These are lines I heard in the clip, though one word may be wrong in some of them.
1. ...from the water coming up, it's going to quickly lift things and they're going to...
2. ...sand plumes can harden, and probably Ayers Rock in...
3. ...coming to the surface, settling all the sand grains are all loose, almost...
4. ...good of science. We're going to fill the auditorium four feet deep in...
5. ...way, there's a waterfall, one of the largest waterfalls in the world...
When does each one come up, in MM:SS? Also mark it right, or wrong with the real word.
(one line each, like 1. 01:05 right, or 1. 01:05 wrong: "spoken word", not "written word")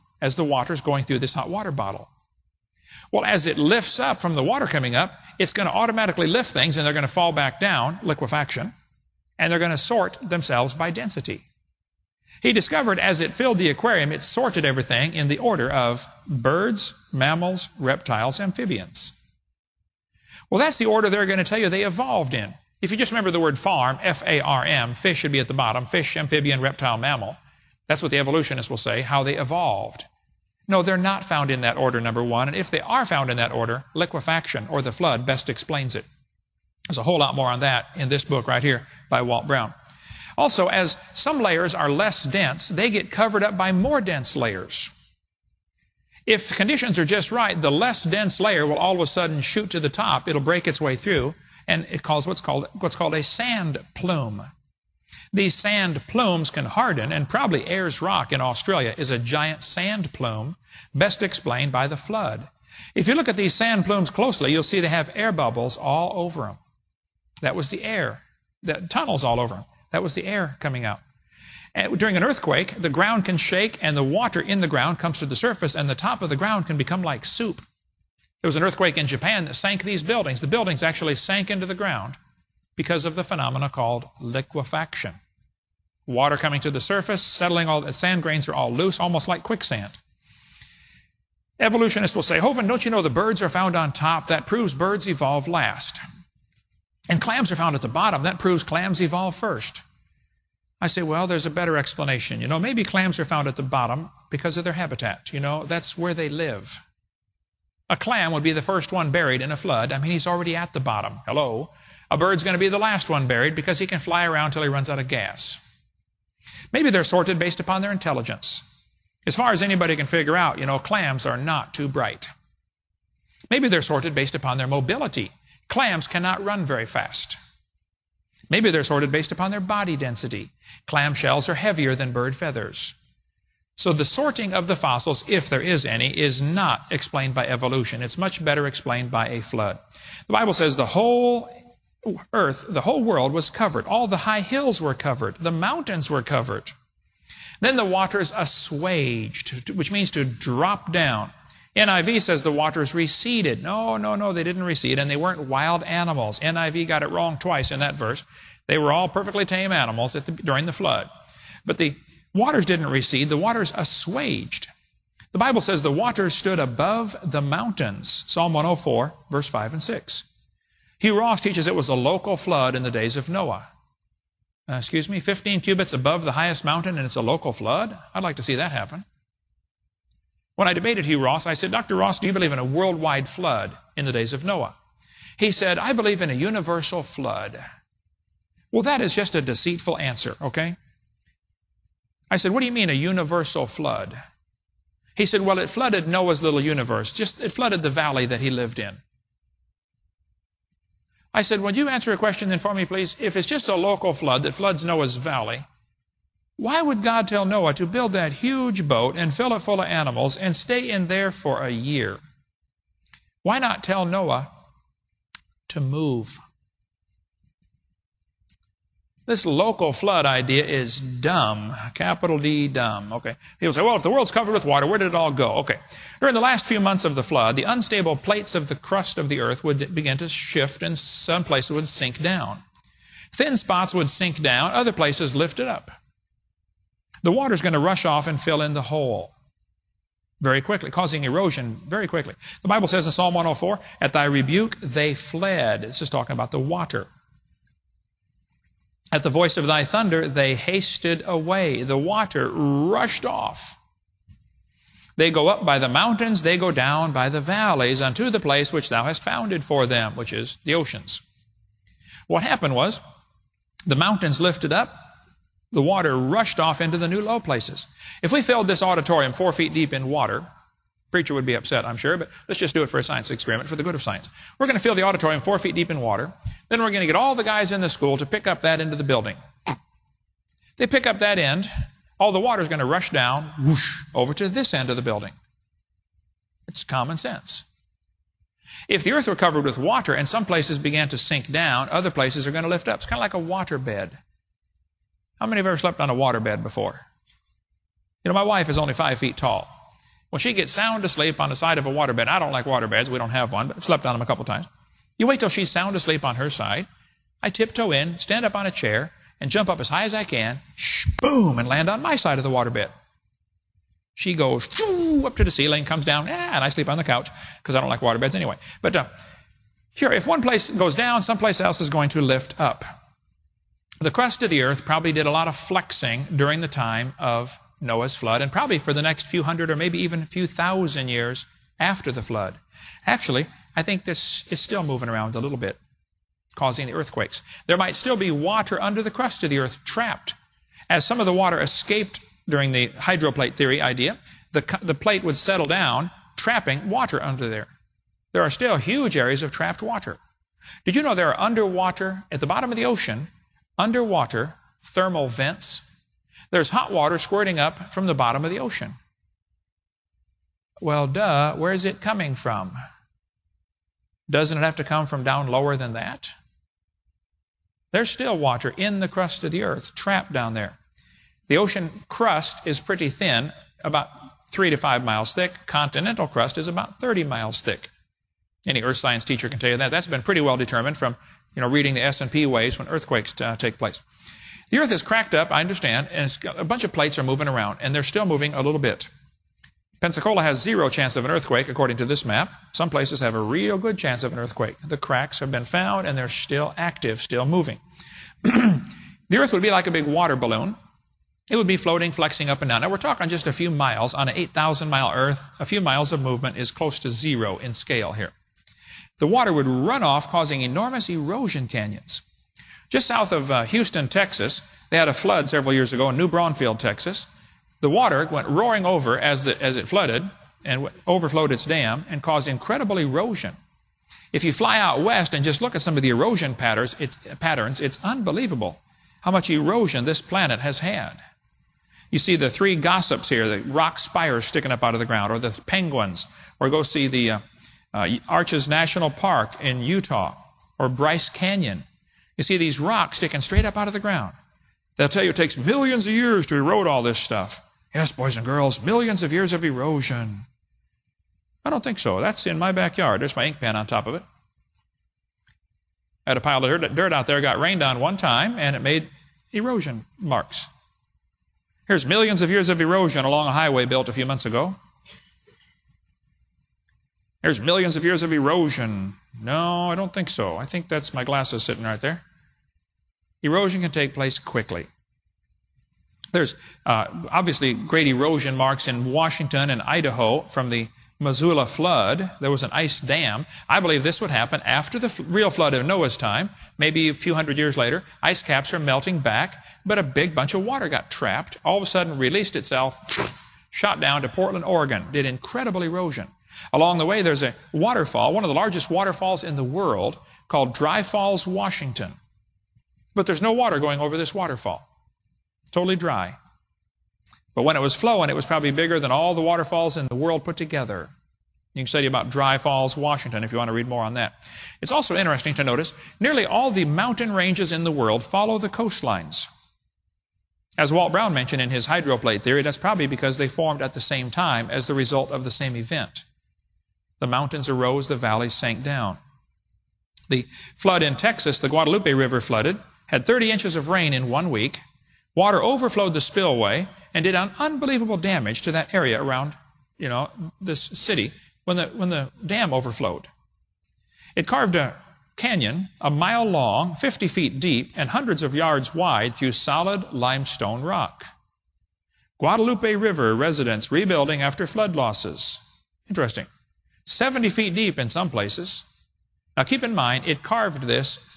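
1. 00:04 wrong: "automatically", not "quickly"
2. 00:55 right
3. 01:26 right
4. 04:33 right
5. 08:17 right.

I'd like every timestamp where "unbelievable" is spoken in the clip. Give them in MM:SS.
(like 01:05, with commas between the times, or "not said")
07:08, 08:57.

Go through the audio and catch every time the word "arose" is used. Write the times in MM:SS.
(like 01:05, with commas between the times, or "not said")
08:47.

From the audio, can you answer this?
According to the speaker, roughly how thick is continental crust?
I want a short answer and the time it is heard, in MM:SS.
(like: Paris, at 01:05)
30 miles, at 06:16.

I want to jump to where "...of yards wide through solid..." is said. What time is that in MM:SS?
09:08.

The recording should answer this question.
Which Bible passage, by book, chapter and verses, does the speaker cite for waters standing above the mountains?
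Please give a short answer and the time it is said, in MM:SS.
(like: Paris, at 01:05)
Psalm 104:5-6, at 02:48.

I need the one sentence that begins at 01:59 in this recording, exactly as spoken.
As far as anybody can figure out, you know, clams are not too bright.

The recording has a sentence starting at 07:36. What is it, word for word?
I had a pile of dirt out there, got rained on one time, and it made erosion marks.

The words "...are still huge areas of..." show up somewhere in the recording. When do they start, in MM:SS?
05:48.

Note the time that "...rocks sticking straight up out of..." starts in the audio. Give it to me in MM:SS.
07:22.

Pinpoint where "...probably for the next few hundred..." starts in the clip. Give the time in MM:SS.
05:28.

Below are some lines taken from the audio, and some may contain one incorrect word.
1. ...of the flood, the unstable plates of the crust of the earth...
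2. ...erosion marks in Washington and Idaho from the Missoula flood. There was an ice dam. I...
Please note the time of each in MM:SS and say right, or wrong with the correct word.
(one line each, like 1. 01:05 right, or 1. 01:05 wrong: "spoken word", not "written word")
1. 03:47 right
2. 07:58 right.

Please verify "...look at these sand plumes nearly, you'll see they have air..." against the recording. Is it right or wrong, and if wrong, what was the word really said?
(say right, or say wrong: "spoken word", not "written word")
wrong: "closely", not "nearly".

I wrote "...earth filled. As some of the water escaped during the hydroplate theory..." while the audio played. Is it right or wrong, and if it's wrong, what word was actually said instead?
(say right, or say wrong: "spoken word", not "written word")
wrong: "trapped", not "filled".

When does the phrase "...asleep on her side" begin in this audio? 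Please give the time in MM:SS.
05:05.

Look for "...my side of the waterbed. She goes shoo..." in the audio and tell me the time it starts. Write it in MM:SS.
05:12.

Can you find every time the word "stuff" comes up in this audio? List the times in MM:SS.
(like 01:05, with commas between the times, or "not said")
07:27.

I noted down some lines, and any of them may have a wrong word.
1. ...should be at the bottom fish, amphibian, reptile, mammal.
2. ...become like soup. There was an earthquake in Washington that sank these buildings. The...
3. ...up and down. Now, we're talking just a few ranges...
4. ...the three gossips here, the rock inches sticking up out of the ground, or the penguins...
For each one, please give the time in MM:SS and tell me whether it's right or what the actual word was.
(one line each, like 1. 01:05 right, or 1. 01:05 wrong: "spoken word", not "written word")
1. 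00:25 right
2. 01:16 wrong: "Japan", not "Washington"
3. 06:42 wrong: "miles", not "ranges"
4. 07:12 wrong: "spires", not "inches".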